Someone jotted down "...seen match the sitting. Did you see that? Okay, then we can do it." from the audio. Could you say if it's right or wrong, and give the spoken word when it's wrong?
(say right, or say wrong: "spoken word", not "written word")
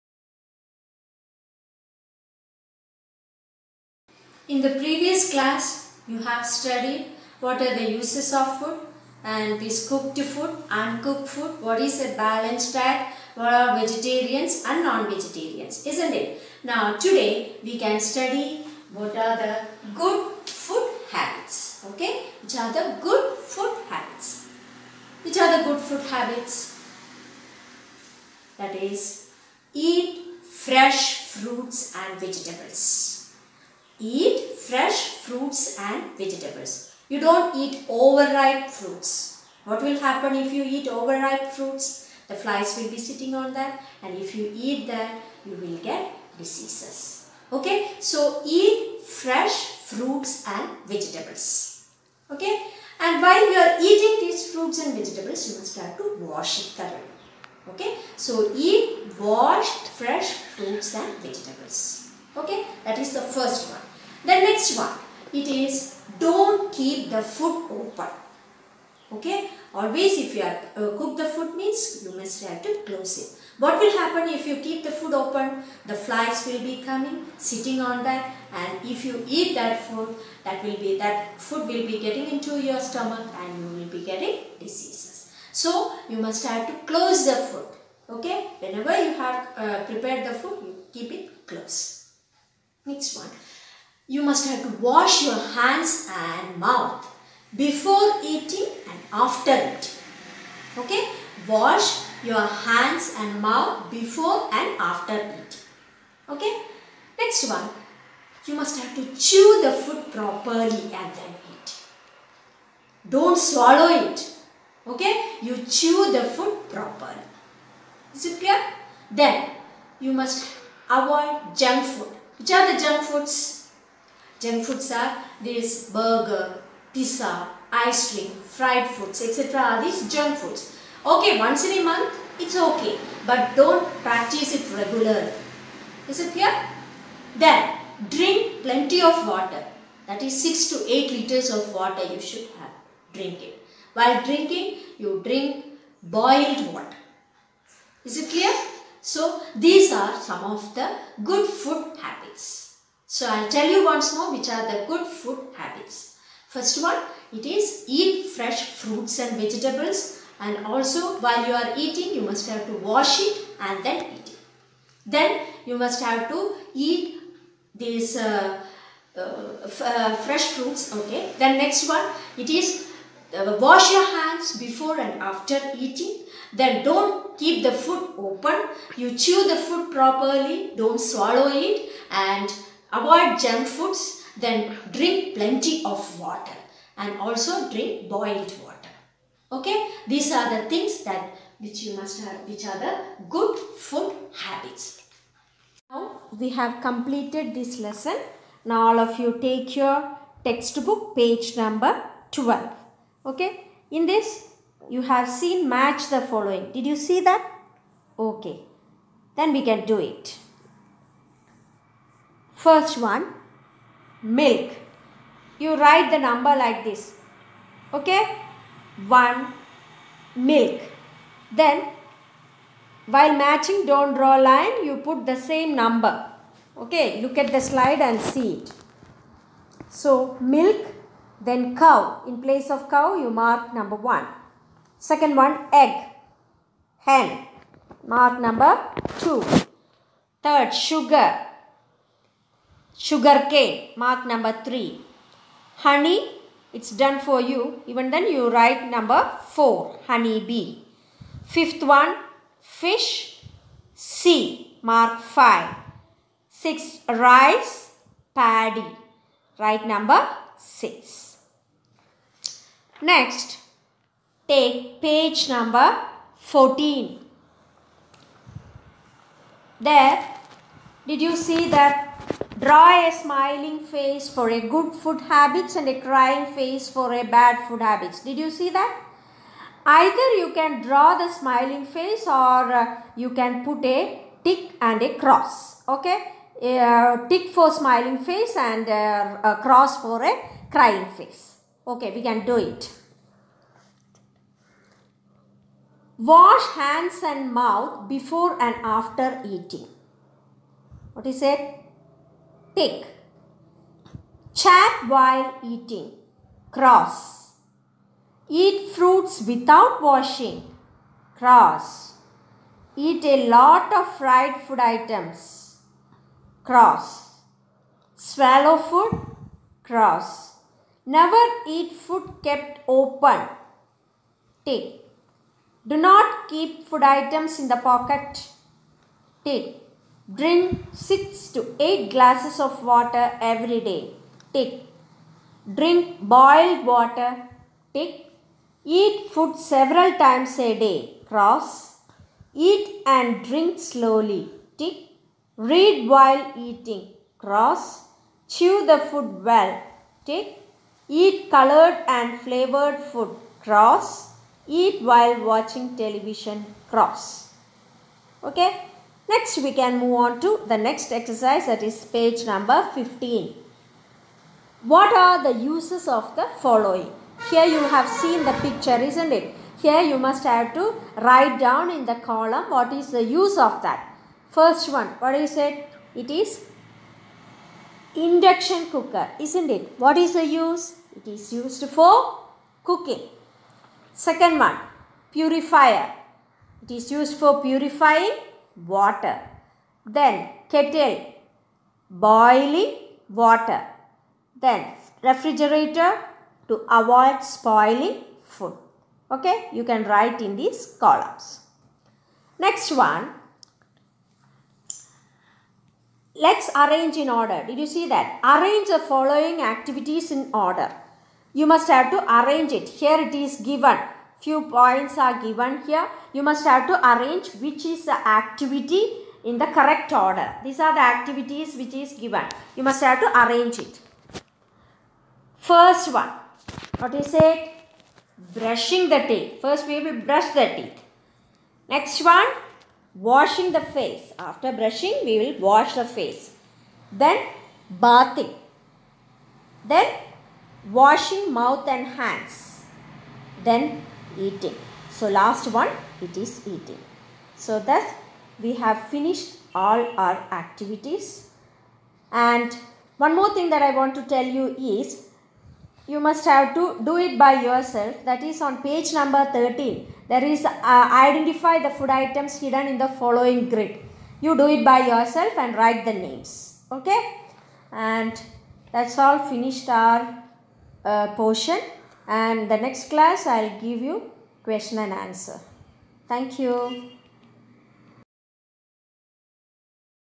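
wrong: "following", not "sitting".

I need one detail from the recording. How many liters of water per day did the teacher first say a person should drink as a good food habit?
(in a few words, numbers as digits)
6 to 8 liters.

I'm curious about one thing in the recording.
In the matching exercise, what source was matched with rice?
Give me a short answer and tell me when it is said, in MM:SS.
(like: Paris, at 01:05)
Paddy, at 04:18.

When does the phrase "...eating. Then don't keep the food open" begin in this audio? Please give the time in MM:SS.
02:55.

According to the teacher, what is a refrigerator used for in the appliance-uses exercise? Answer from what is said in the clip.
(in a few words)
To avoid spoiling food.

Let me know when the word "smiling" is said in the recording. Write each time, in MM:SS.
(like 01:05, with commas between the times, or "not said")
04:33, 04:41, 04:47.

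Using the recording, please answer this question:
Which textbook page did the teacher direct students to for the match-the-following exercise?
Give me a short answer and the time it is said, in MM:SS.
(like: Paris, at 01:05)
12, at 03:21.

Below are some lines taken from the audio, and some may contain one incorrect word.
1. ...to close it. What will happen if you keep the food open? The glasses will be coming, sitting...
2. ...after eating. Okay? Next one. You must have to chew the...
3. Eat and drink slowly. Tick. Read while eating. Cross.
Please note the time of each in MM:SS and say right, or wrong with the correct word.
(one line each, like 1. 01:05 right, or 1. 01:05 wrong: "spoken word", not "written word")
1. 01:12 wrong: "flies", not "glasses"
2. 01:44 right
3. 05:42 right.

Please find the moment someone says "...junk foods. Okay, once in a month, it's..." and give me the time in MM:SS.
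02:10.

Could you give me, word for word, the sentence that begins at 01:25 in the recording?
So, you must have to close the food.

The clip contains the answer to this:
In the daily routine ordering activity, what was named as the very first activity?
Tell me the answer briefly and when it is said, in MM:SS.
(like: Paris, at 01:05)
Brushing the teeth, at 07:08.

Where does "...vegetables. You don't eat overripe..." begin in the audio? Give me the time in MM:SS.
00:36.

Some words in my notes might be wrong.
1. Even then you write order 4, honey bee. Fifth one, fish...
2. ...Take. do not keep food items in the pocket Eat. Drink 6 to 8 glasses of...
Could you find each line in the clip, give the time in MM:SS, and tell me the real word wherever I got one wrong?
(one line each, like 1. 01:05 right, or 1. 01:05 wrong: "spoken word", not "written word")
1. 04:07 wrong: "number", not "order"
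2. 05:24 wrong: "Take", not "Eat".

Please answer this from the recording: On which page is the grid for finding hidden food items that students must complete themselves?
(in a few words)
13.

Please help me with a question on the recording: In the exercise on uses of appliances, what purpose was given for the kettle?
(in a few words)
Boiling water.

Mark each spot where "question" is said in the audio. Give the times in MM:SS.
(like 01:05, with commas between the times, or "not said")
07:54.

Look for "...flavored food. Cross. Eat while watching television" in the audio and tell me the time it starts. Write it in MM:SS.
05:52.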